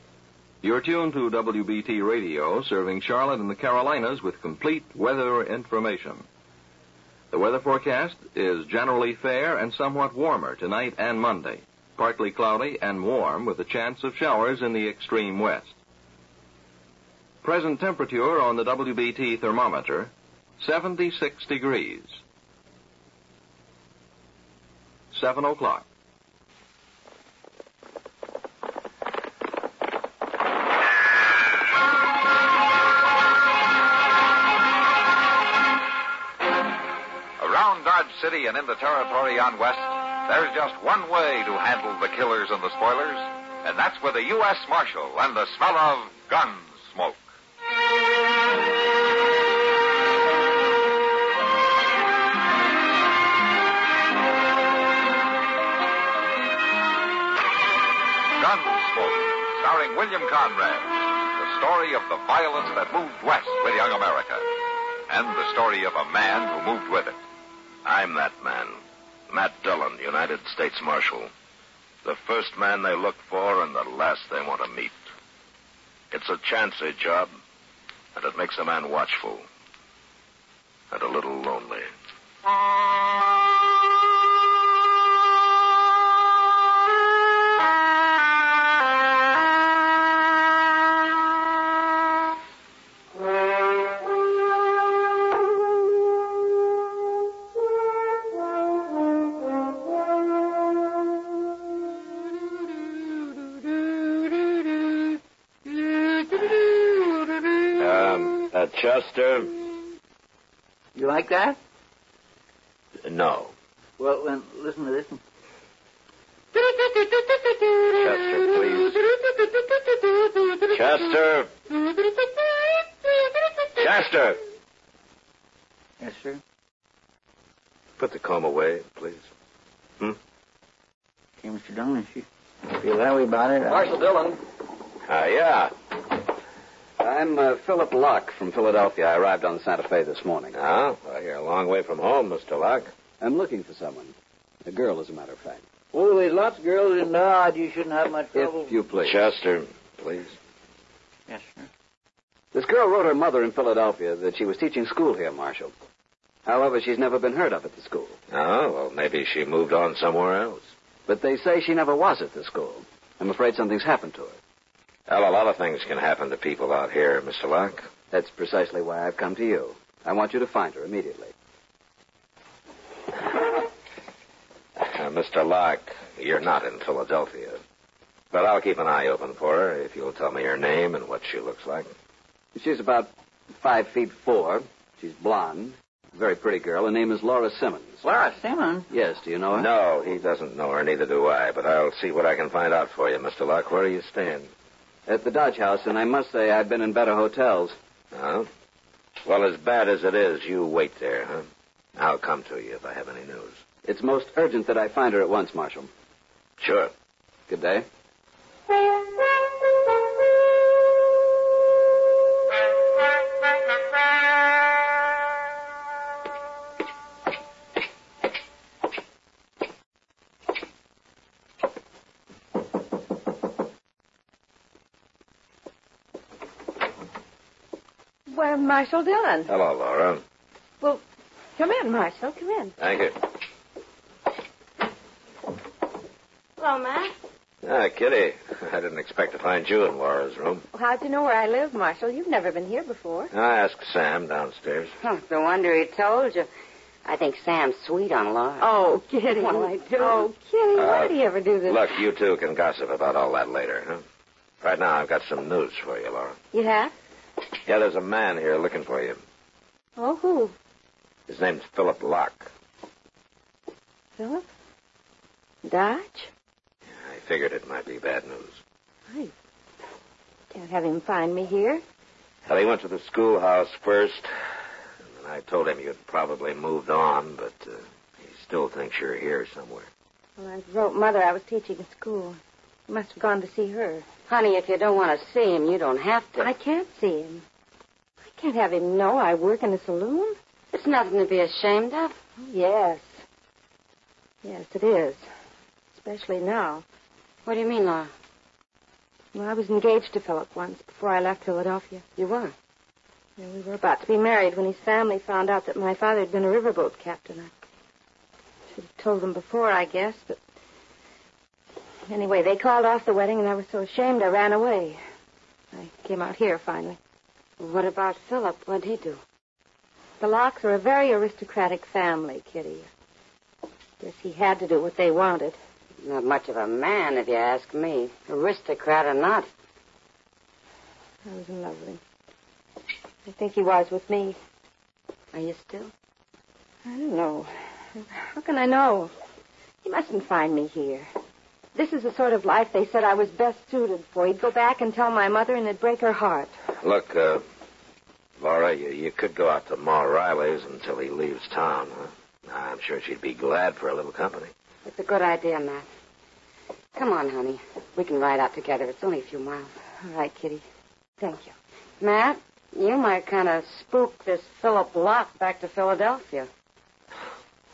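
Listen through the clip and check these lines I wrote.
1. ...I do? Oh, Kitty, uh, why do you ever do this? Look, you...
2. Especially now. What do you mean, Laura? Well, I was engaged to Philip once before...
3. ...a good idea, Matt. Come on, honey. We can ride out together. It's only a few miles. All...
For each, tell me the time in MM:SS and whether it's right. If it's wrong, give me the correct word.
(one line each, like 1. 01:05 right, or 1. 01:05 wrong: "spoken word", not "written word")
1. 04:09 right
2. 04:55 right
3. 05:54 right.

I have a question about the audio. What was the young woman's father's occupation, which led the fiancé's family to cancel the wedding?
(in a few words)
riverboat captain.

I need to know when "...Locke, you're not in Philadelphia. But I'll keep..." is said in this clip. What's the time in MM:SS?
02:55.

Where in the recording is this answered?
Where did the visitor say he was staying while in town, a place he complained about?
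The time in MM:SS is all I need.
03:15.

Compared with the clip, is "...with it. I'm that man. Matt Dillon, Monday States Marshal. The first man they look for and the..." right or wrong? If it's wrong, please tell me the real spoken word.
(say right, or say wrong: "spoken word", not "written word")
wrong: "United", not "Monday".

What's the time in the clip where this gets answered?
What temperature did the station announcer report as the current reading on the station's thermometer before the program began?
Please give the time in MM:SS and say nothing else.
00:20.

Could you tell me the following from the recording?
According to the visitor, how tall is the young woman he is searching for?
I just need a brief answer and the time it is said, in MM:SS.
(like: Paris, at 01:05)
5 feet 4, at 03:03.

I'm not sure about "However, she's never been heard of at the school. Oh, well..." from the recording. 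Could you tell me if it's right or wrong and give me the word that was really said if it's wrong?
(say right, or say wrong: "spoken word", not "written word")
right.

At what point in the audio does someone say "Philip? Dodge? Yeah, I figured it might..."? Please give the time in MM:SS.
04:24.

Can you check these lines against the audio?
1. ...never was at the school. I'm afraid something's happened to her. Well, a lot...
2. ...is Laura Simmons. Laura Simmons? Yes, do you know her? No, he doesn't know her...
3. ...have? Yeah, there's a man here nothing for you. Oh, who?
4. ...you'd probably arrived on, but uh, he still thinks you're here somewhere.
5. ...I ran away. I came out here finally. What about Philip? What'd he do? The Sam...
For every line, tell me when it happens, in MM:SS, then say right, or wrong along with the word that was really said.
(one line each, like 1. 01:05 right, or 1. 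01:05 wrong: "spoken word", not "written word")
1. 02:41 right
2. 03:07 right
3. 04:16 wrong: "looking", not "nothing"
4. 04:35 wrong: "moved", not "arrived"
5. 05:14 wrong: "Lockes", not "Sam".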